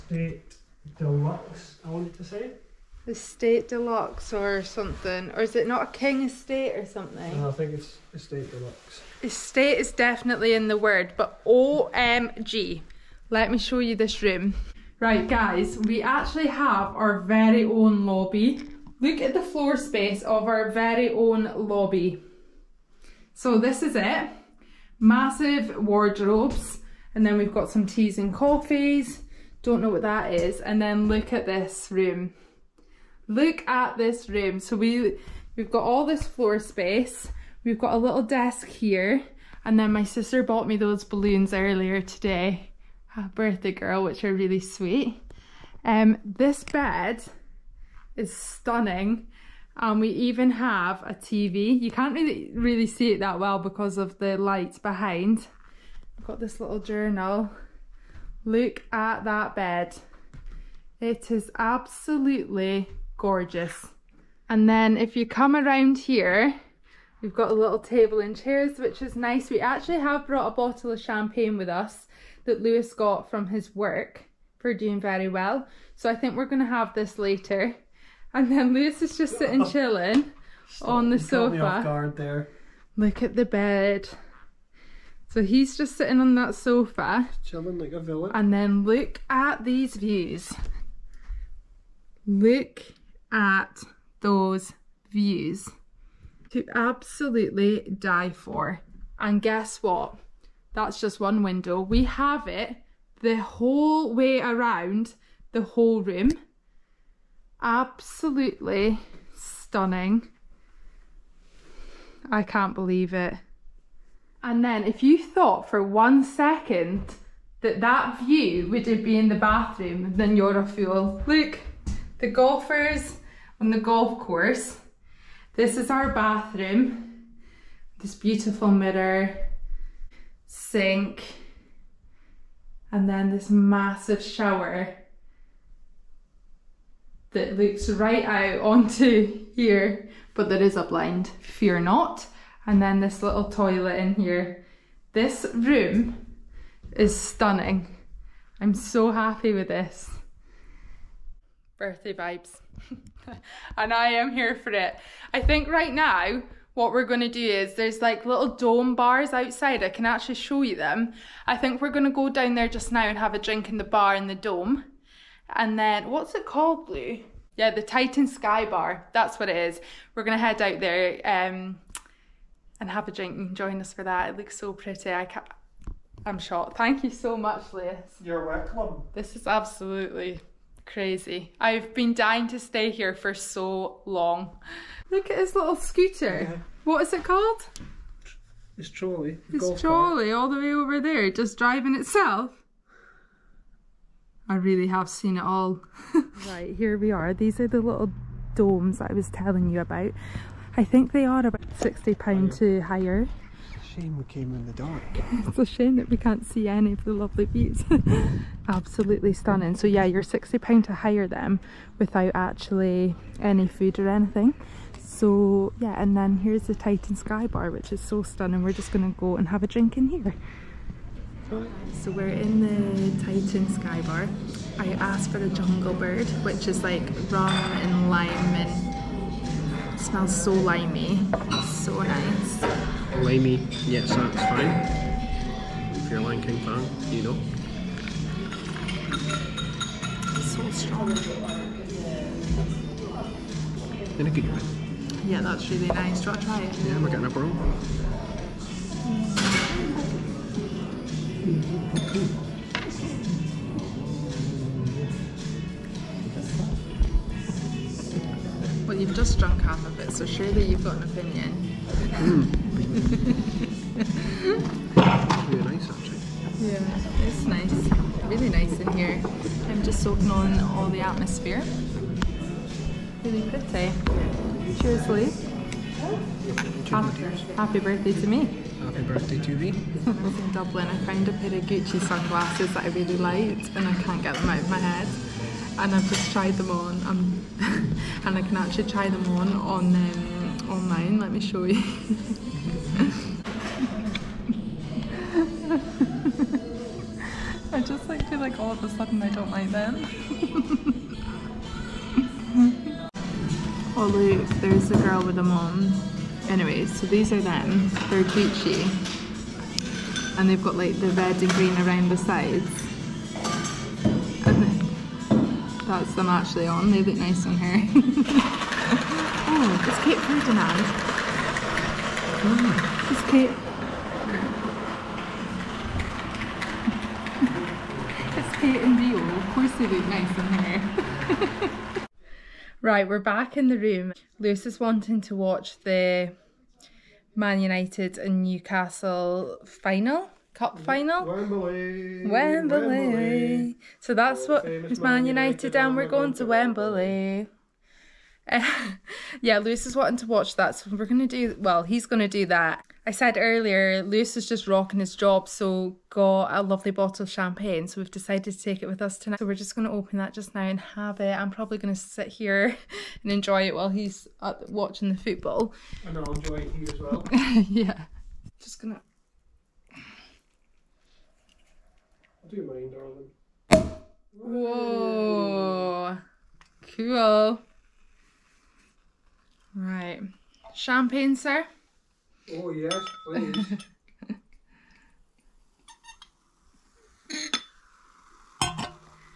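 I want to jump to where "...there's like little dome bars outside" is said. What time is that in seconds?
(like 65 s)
157 s.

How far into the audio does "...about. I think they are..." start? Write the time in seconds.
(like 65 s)
199 s.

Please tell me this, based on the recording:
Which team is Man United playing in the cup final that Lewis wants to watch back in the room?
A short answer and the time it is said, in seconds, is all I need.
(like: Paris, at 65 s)
Newcastle, at 338 s.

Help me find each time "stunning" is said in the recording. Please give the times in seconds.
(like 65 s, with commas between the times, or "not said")
48 s, 109 s, 147 s, 209 s, 218 s.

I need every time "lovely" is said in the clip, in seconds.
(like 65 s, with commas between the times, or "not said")
207 s, 356 s.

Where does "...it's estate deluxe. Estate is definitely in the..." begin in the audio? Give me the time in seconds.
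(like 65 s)
7 s.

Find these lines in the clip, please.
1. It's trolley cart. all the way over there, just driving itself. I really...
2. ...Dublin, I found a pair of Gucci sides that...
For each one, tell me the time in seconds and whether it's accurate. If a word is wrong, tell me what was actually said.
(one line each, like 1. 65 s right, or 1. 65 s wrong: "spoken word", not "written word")
1. 189 s right
2. 280 s wrong: "sunglasses", not "sides".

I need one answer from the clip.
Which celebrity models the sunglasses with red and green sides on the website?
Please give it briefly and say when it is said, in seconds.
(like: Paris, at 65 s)
Kate Ferdinand, at 320 s.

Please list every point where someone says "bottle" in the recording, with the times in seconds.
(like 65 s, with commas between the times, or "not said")
70 s, 356 s.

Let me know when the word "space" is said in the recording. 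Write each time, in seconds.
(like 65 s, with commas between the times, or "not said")
19 s, 36 s.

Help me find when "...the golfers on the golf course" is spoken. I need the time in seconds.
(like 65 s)
122 s.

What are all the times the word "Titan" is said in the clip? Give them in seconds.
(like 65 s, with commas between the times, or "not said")
167 s, 216 s, 223 s.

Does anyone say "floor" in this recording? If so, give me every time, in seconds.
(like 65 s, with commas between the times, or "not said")
19 s, 36 s.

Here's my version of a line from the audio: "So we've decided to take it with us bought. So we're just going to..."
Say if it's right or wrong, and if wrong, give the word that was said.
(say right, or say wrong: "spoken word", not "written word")
wrong: "tonight", not "bought".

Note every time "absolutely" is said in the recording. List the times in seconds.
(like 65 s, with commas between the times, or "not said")
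61 s, 96 s, 107 s, 179 s, 208 s.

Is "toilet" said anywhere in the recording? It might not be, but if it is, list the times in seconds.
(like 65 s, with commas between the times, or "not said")
143 s.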